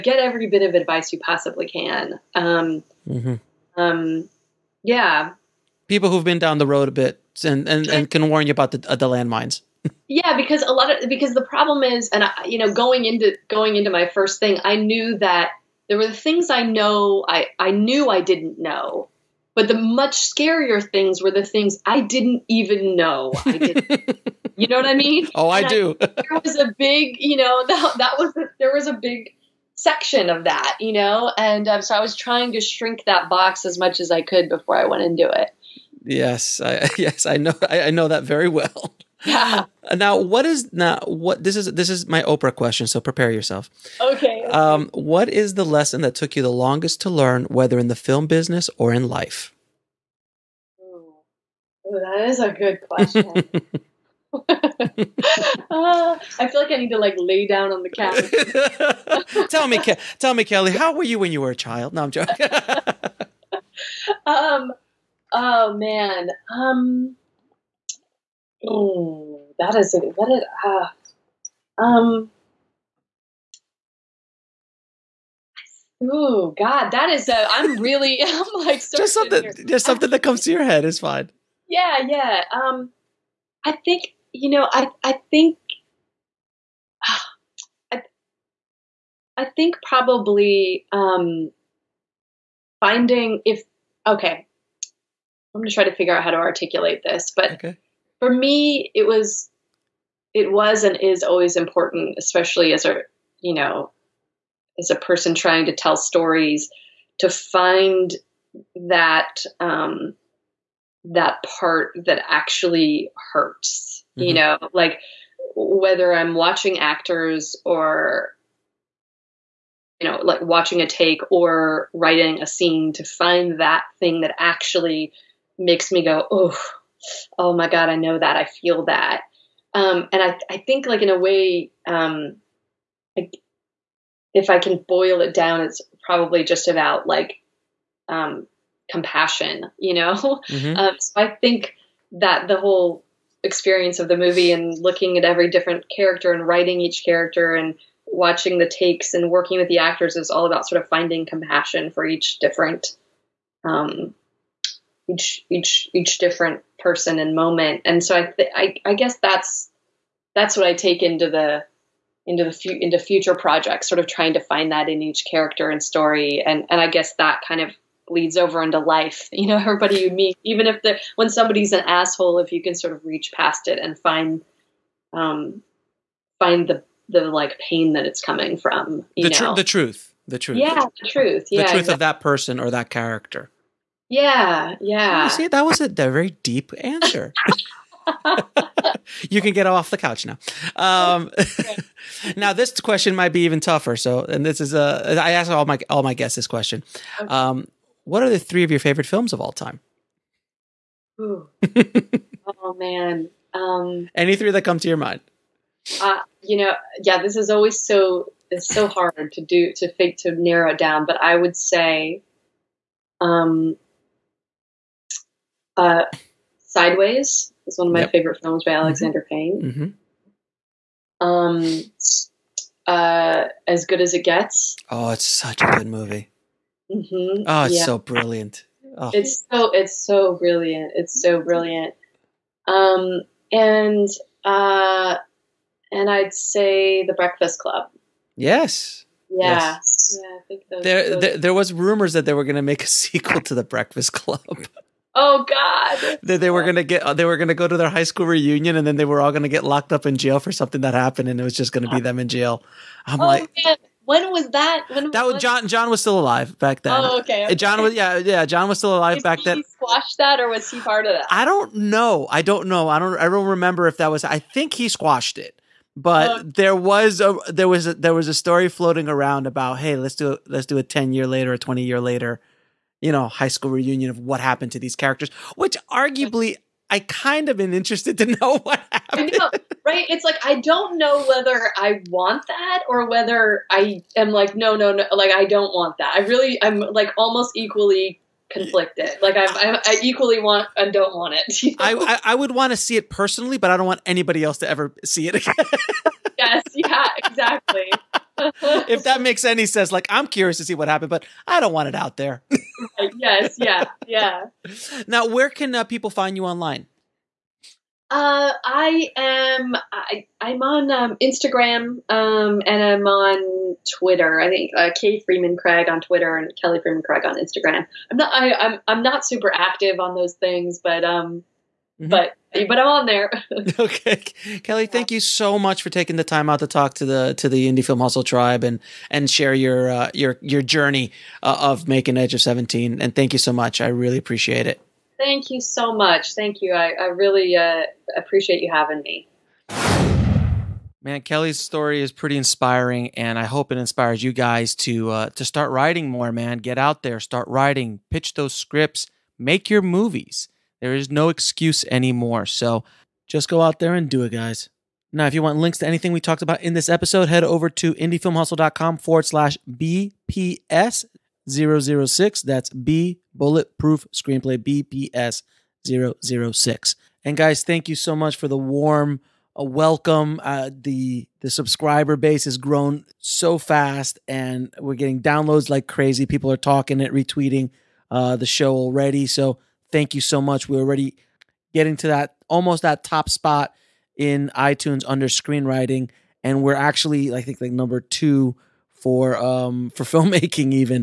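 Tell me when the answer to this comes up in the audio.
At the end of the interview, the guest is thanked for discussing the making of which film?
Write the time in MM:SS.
05:32.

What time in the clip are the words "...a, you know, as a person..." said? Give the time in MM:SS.
01:42.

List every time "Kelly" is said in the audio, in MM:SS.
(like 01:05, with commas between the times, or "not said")
01:00, 05:16, 05:24, 05:41.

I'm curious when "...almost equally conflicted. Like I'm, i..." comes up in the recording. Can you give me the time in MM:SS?
04:47.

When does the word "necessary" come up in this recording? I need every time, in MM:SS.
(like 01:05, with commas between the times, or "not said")
not said.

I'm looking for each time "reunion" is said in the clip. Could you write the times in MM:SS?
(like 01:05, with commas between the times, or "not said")
04:08, 04:33.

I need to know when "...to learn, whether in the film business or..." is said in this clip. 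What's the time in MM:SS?
00:47.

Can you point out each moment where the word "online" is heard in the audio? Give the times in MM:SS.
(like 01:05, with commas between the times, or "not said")
05:06.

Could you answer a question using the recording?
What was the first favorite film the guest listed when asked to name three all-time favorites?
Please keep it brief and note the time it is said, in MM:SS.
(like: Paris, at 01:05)
Sideways, at 03:36.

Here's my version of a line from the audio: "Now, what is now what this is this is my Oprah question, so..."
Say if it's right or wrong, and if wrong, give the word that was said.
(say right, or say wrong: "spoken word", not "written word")
right.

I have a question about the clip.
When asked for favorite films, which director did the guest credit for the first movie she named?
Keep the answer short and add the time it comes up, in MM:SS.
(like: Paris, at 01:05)
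Alexander Payne, at 03:38.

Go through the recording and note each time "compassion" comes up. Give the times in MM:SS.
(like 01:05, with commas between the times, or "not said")
02:18, 02:31.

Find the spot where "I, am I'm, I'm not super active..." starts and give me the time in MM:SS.
05:18.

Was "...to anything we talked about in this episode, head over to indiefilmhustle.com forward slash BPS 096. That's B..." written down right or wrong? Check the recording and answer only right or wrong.
wrong.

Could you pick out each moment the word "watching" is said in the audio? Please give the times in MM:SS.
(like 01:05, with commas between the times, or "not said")
01:56, 02:00, 02:28.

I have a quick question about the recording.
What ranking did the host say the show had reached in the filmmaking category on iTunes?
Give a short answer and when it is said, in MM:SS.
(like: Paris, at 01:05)
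number 2, at 06:27.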